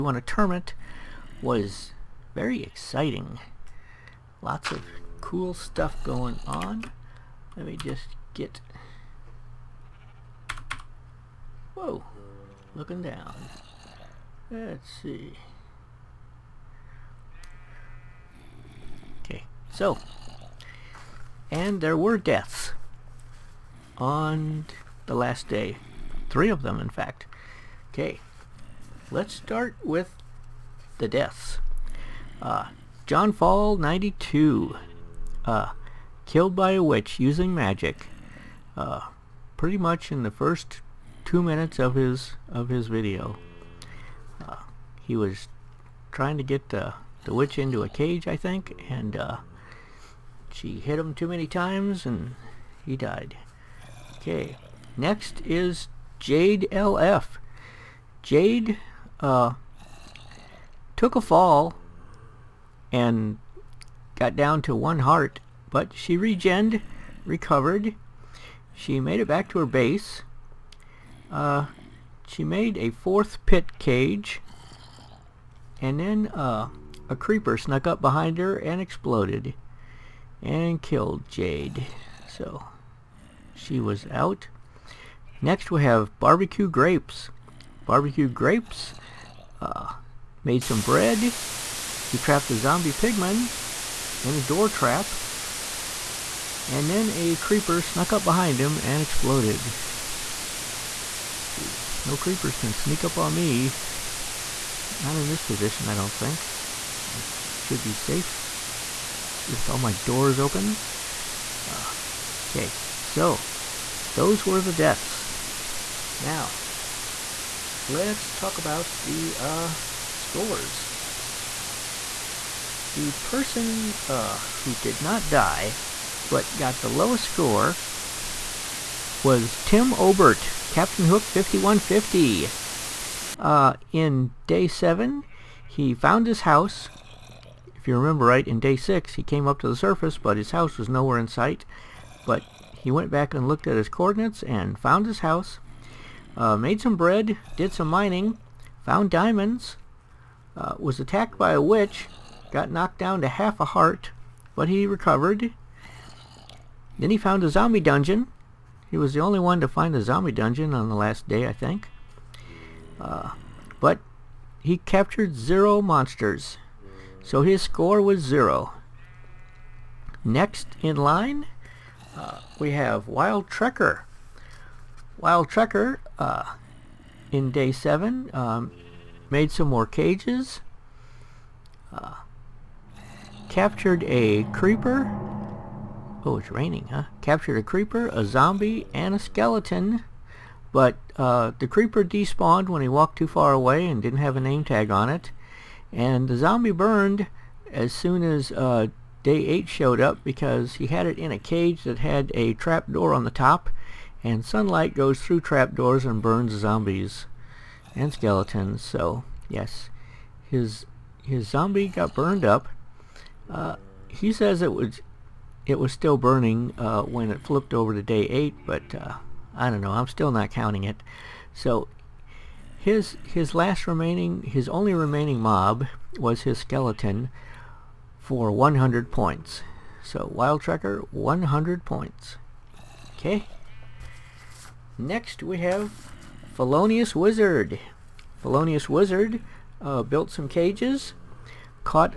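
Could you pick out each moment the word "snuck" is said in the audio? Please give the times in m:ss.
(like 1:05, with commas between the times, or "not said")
1:17, 1:37.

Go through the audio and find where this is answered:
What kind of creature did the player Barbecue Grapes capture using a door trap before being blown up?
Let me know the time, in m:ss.
1:32.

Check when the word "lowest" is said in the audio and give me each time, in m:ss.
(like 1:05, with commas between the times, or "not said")
2:06.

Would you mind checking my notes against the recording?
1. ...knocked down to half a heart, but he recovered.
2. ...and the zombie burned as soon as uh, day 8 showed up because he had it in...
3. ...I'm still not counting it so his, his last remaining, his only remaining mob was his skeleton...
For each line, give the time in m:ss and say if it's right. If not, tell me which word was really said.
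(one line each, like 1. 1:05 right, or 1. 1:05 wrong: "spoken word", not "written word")
1. 2:32 right
2. 3:15 right
3. 3:39 right.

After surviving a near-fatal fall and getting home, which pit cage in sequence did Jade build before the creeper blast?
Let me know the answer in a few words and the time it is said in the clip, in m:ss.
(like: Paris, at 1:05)
fourth, at 1:12.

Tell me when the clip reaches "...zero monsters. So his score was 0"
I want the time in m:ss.
2:45.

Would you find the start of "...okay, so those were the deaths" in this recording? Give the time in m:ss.
1:52.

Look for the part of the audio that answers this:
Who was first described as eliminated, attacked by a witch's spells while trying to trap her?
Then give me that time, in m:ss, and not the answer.
0:33.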